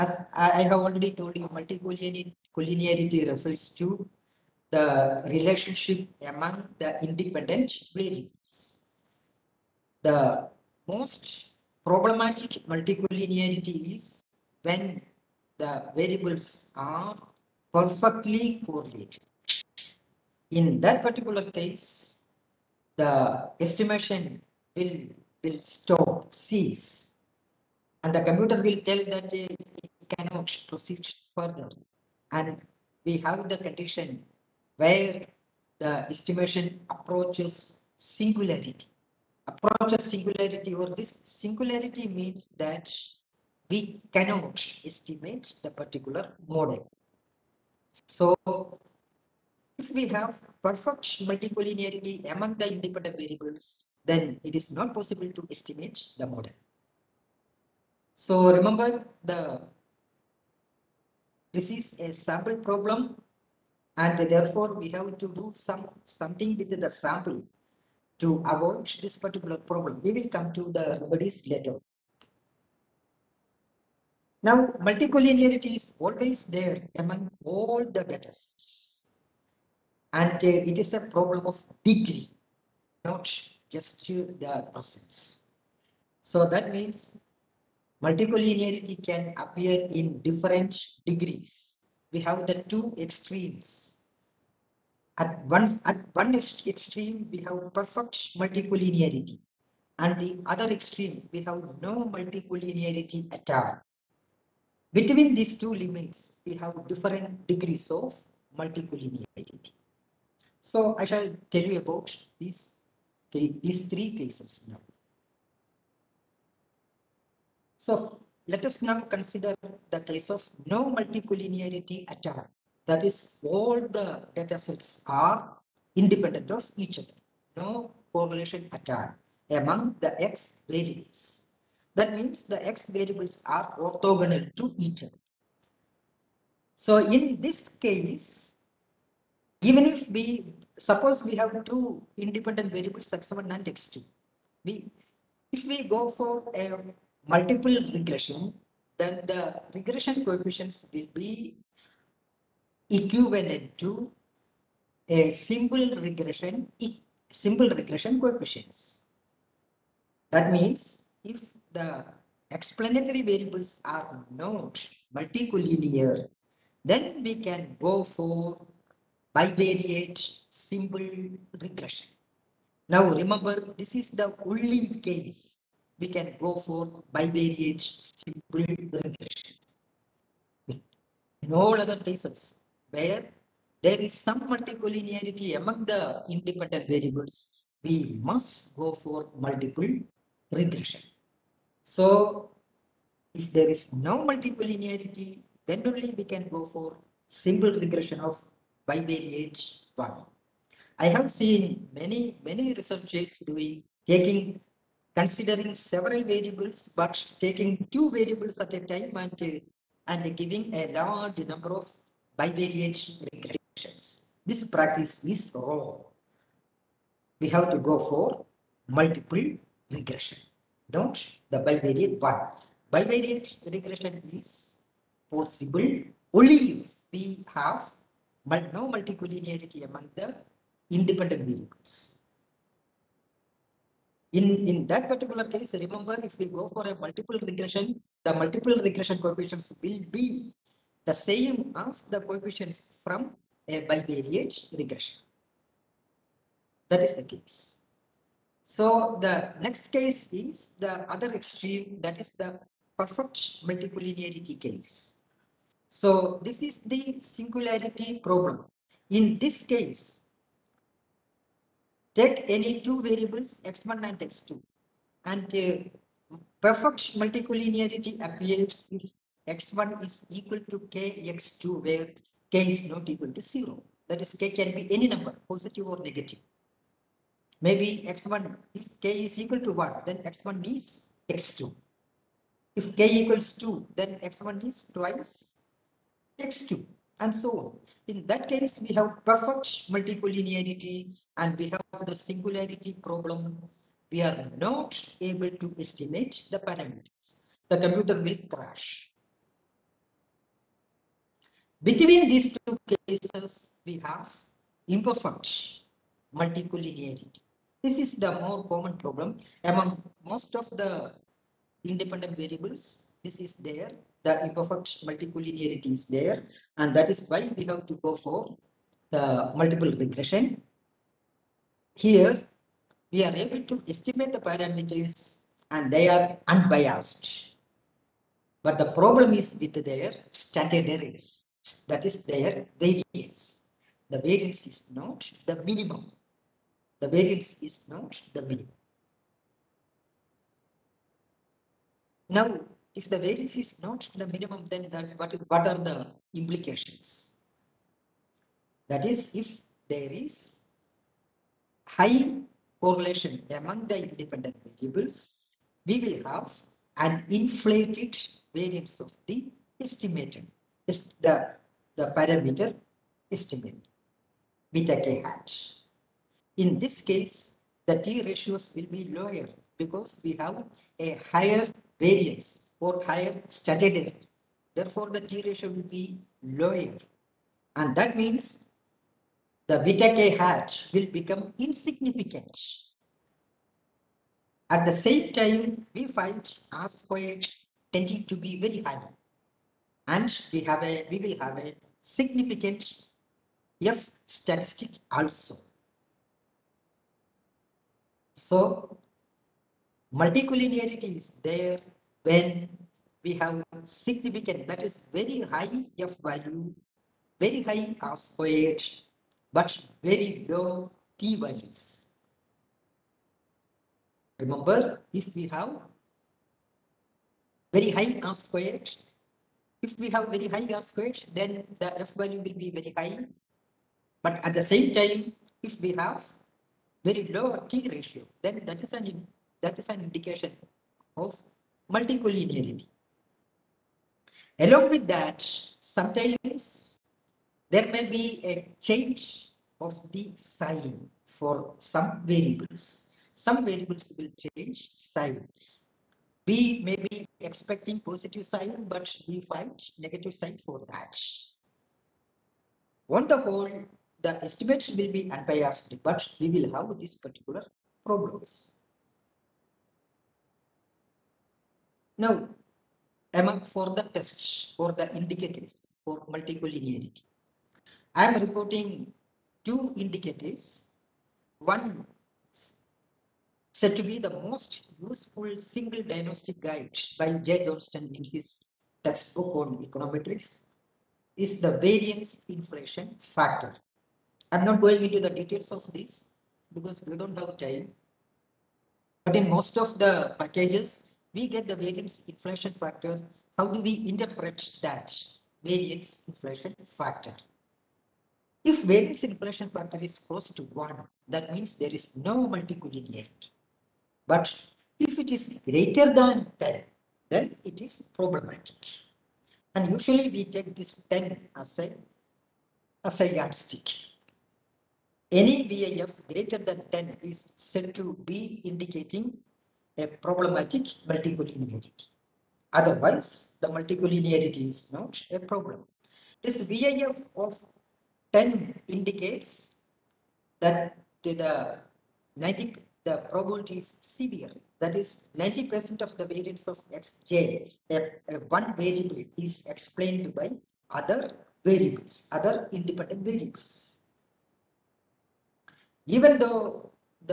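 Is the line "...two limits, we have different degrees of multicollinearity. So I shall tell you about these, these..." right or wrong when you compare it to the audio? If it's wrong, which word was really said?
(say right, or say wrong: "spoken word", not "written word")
right.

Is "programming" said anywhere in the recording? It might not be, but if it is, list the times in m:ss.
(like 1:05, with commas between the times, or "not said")
not said.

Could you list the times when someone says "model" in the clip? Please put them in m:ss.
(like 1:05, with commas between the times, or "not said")
0:46, 0:56.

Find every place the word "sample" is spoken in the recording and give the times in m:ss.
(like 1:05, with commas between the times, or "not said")
1:02, 1:06.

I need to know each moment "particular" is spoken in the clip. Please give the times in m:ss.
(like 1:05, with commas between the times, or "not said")
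0:21, 0:45, 1:09, 3:55, 7:37.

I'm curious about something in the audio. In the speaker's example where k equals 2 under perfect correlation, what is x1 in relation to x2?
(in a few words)
Twice x2.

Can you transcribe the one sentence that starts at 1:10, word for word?
We will come to the remedies later.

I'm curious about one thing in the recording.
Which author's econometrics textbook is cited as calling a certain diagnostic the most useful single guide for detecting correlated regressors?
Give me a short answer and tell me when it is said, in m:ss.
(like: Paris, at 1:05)
J. Johnston, at 7:57.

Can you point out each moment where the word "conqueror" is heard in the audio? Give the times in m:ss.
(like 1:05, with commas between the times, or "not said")
not said.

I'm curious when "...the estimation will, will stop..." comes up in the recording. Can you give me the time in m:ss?
0:22.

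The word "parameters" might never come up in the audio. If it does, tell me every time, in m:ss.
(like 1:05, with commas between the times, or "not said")
4:56, 5:24, 6:02.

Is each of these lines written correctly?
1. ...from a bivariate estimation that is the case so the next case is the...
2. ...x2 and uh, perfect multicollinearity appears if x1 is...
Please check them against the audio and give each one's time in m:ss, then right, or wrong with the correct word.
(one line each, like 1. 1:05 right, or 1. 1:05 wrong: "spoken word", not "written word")
1. 4:03 wrong: "regression", not "estimation"
2. 4:24 right.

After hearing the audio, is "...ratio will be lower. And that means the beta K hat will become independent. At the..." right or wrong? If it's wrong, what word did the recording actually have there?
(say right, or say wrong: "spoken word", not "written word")
wrong: "insignificant", not "independent".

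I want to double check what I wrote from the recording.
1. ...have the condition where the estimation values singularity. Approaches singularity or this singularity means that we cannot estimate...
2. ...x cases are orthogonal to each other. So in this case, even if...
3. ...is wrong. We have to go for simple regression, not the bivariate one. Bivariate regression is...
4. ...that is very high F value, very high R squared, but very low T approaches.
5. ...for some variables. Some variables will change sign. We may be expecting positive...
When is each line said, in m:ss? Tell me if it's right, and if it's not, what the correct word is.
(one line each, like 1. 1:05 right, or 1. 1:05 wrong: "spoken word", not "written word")
1. 0:33 wrong: "approaches", not "values"
2. 2:12 wrong: "variables", not "cases"
3. 3:35 wrong: "multiple", not "simple"
4. 6:44 wrong: "values", not "approaches"
5. 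7:21 right.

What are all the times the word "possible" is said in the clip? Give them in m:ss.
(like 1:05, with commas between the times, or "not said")
0:54, 3:45.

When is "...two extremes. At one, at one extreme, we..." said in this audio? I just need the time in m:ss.
1:32.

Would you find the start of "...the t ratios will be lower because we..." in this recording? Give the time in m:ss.
6:07.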